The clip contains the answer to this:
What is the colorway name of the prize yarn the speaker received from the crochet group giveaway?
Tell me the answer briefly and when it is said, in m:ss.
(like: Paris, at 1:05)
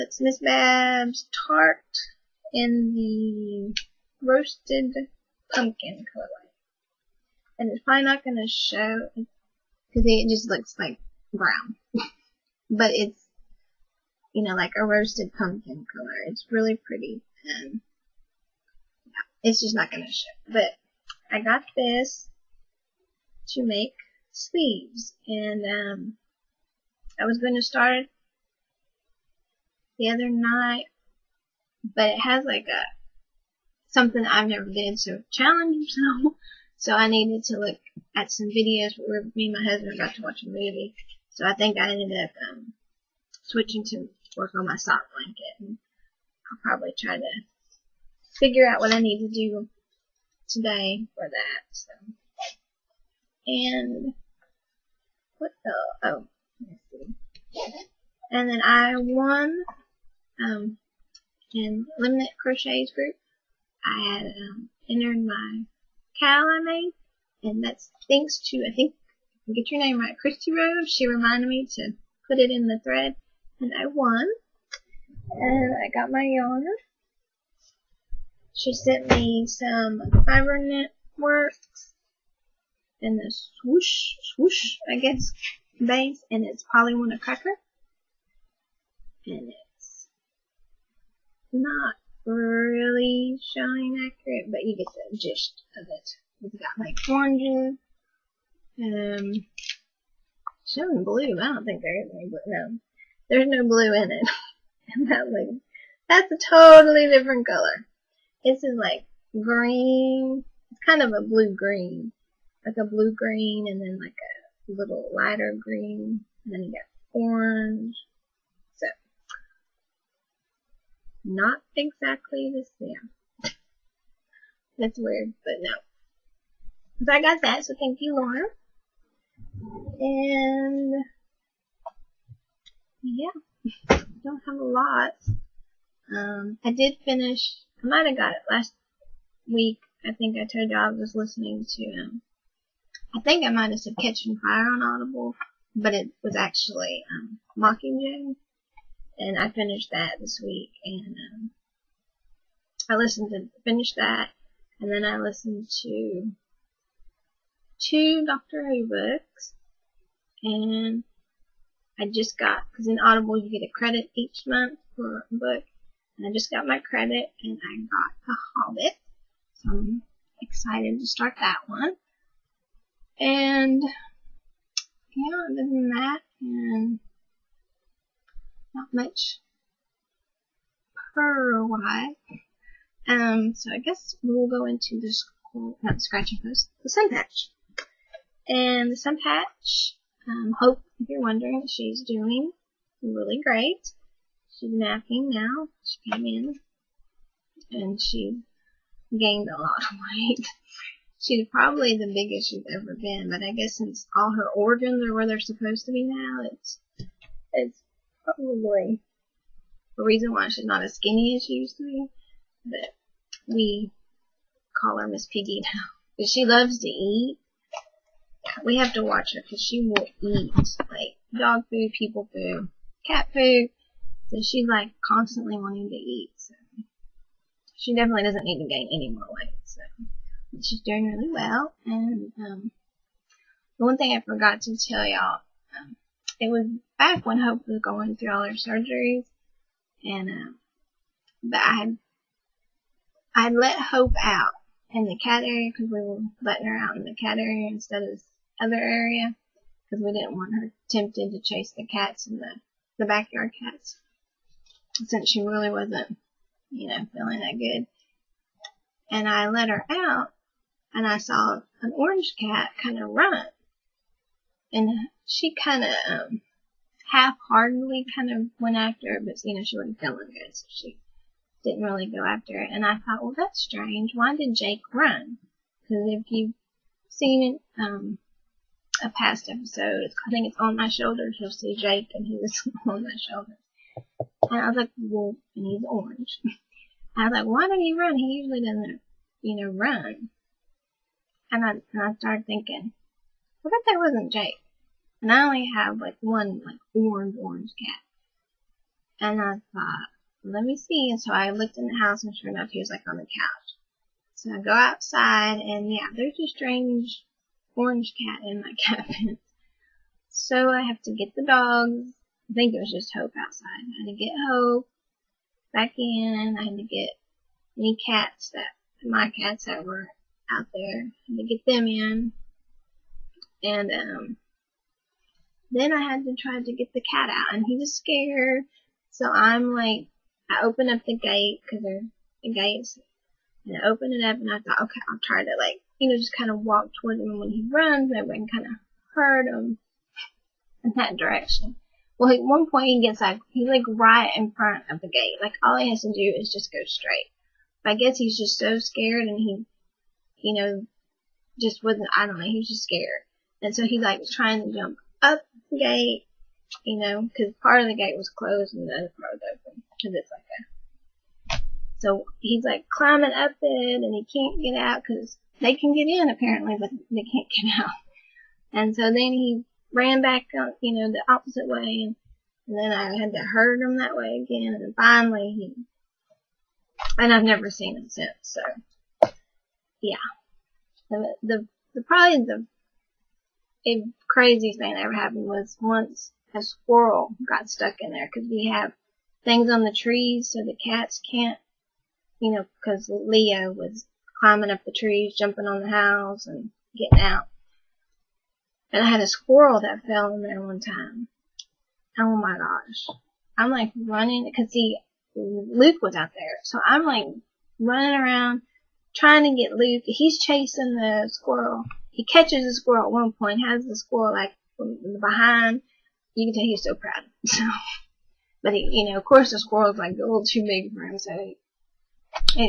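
Polly Cracker, at 1:26.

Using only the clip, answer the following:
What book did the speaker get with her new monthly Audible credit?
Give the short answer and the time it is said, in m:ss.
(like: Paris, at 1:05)
The Hobbit, at 2:48.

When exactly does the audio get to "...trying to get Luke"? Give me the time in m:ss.
6:49.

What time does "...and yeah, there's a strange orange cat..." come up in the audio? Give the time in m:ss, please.
5:05.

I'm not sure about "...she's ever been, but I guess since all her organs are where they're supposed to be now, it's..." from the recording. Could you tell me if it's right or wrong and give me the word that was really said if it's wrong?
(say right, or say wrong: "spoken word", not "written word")
right.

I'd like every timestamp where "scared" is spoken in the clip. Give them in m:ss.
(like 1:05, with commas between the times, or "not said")
5:27, 5:48, 5:52.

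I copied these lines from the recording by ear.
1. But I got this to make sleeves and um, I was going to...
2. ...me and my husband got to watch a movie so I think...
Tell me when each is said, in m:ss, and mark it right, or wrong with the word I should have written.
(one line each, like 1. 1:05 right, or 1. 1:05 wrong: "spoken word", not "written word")
1. 0:20 right
2. 0:39 right.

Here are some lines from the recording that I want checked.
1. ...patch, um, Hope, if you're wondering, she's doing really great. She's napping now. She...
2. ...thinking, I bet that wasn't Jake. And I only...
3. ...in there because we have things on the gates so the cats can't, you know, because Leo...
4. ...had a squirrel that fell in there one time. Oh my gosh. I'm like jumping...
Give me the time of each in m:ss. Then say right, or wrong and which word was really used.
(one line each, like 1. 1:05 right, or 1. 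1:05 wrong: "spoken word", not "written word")
1. 3:09 right
2. 4:52 right
3. 6:27 wrong: "trees", not "gates"
4. 6:39 wrong: "running", not "jumping".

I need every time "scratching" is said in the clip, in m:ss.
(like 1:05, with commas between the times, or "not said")
3:06.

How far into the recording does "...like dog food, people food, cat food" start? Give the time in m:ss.
3:40.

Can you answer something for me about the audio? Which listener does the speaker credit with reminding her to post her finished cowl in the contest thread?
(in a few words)
Christy Rose.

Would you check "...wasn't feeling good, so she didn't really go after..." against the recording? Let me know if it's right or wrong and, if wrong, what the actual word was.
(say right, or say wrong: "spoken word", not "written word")
right.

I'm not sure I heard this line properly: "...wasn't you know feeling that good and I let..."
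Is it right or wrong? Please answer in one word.
right.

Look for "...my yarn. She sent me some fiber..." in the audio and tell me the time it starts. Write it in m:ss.
1:16.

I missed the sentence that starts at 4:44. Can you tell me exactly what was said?
And I was like, well, and he's orange.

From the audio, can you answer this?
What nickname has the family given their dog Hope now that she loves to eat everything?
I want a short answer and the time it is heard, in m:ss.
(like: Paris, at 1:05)
Miss Piggy, at 3:35.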